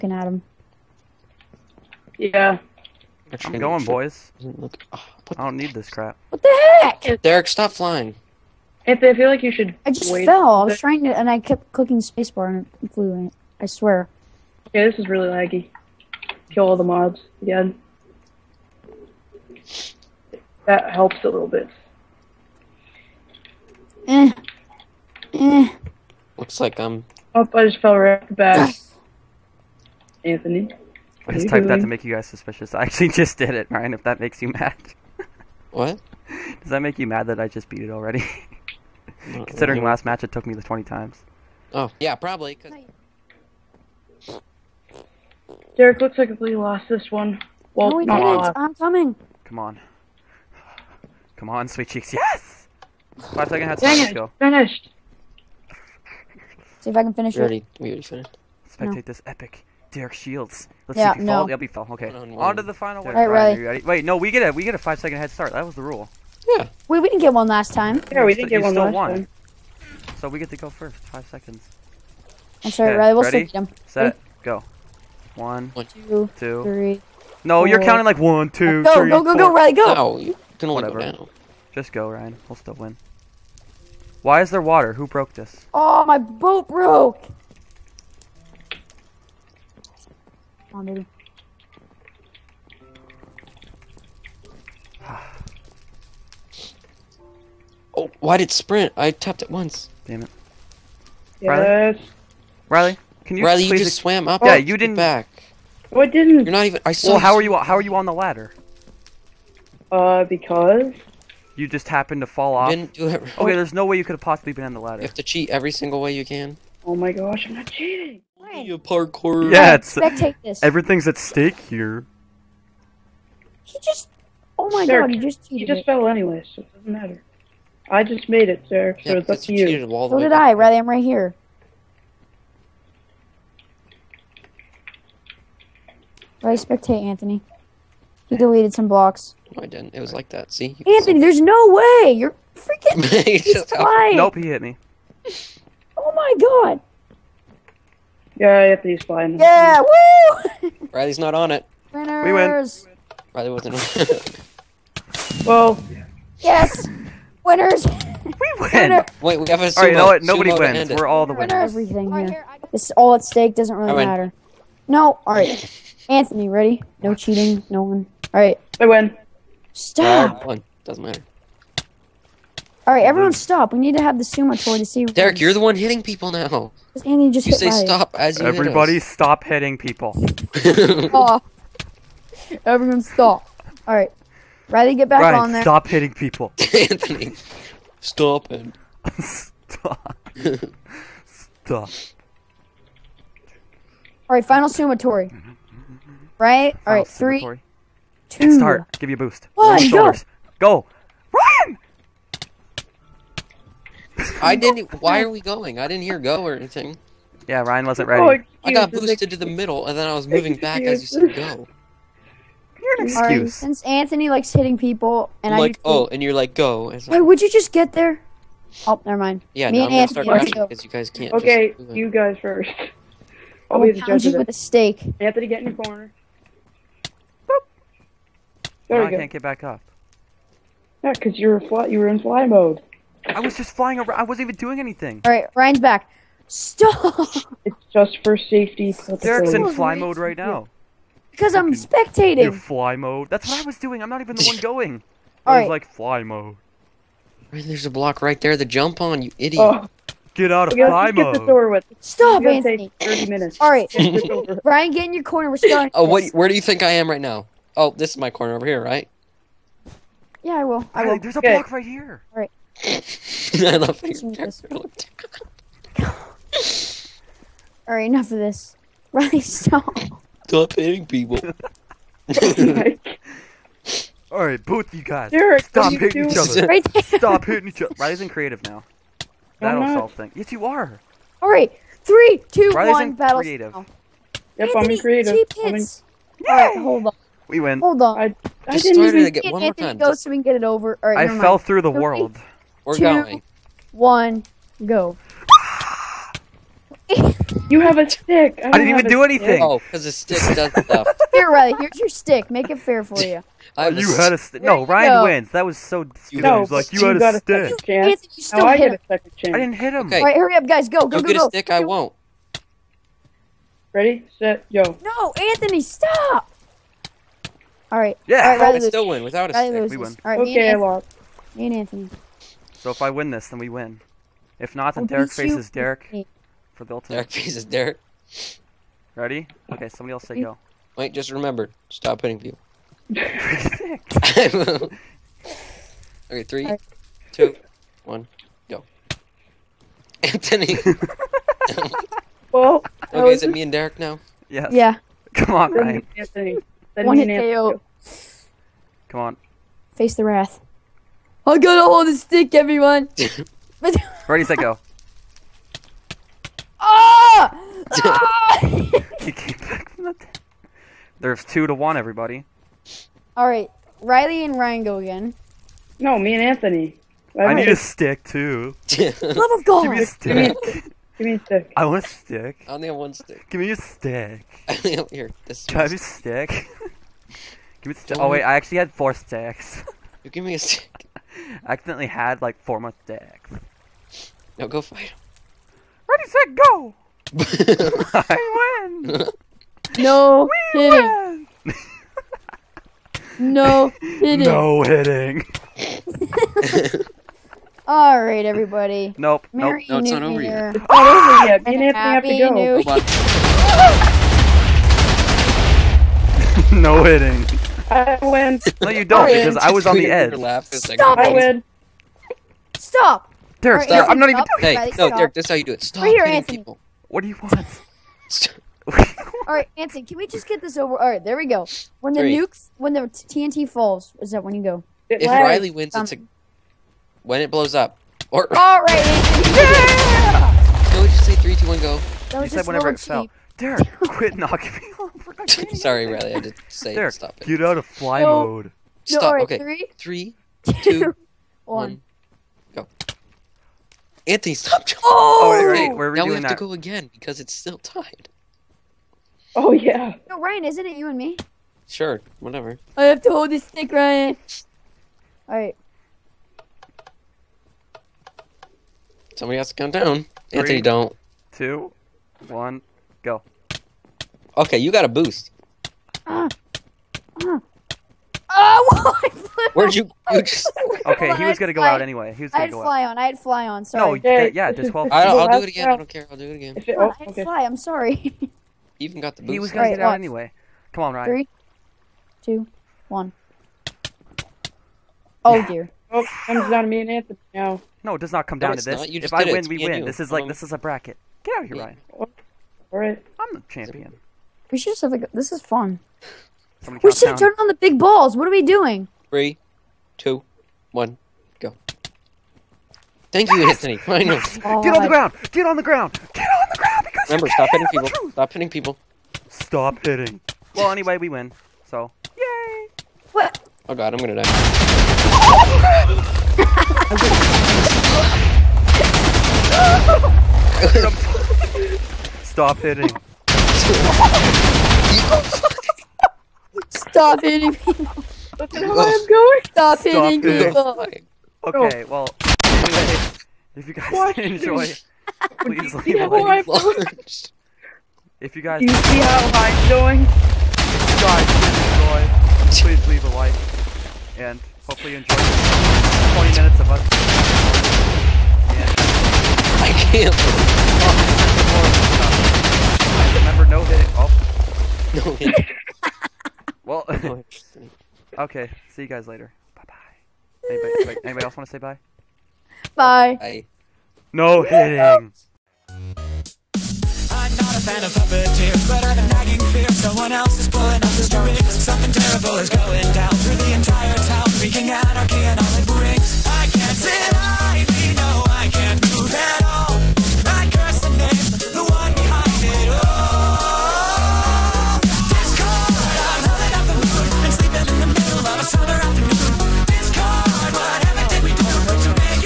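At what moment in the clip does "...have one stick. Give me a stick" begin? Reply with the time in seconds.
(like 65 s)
372 s.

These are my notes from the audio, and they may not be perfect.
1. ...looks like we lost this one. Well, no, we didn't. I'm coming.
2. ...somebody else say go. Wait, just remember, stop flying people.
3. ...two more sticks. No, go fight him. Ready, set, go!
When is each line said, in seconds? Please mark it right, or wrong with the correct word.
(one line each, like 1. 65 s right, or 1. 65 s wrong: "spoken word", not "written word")
1. 46 s right
2. 329 s wrong: "hitting", not "flying"
3. 382 s wrong: "four", not "two".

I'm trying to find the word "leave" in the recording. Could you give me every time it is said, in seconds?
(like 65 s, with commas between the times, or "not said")
536 s, 543 s.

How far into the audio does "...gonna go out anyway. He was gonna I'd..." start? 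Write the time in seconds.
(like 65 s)
471 s.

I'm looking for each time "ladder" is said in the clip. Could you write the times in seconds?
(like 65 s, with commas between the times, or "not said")
108 s, 114 s.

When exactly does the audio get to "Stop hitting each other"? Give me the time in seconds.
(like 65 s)
277 s.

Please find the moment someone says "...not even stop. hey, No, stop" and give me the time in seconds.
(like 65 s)
414 s.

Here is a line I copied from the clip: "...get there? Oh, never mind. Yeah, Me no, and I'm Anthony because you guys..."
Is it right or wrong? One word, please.
right.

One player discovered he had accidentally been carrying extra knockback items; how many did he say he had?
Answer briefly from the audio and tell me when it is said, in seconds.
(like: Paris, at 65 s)
4, at 378 s.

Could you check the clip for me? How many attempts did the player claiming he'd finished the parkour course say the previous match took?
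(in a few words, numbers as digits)
20.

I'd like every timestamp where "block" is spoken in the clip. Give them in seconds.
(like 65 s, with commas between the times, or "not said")
138 s, 247 s, 261 s.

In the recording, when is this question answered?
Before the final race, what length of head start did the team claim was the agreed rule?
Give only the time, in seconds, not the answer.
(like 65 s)
64 s.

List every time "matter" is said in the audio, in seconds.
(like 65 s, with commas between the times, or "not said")
126 s, 164 s, 171 s.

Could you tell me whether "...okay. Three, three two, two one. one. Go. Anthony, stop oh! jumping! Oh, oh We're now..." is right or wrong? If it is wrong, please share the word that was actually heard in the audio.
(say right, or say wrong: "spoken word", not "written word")
right.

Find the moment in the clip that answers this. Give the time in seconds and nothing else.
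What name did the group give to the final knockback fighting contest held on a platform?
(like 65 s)
159 s.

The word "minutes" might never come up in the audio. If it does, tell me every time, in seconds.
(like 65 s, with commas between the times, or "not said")
253 s, 546 s.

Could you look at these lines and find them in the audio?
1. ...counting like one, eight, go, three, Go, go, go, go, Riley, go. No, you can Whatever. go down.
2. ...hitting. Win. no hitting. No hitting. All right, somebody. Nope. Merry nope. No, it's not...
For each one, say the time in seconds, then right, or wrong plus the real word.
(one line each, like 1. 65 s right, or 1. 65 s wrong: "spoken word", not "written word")
1. 77 s wrong: "two", not "eight"
2. 390 s wrong: "everybody", not "somebody".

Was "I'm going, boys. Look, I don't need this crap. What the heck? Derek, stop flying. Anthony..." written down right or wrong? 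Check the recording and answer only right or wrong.
right.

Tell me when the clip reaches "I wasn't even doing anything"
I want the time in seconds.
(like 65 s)
234 s.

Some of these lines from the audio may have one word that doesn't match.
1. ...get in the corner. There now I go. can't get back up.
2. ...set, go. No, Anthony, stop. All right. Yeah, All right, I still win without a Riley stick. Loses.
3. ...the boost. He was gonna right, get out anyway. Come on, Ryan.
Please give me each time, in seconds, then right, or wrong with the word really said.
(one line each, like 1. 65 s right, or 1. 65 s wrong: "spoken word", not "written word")
1. 225 s right
2. 314 s right
3. 479 s right.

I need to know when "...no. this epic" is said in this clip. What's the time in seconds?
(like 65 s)
58 s.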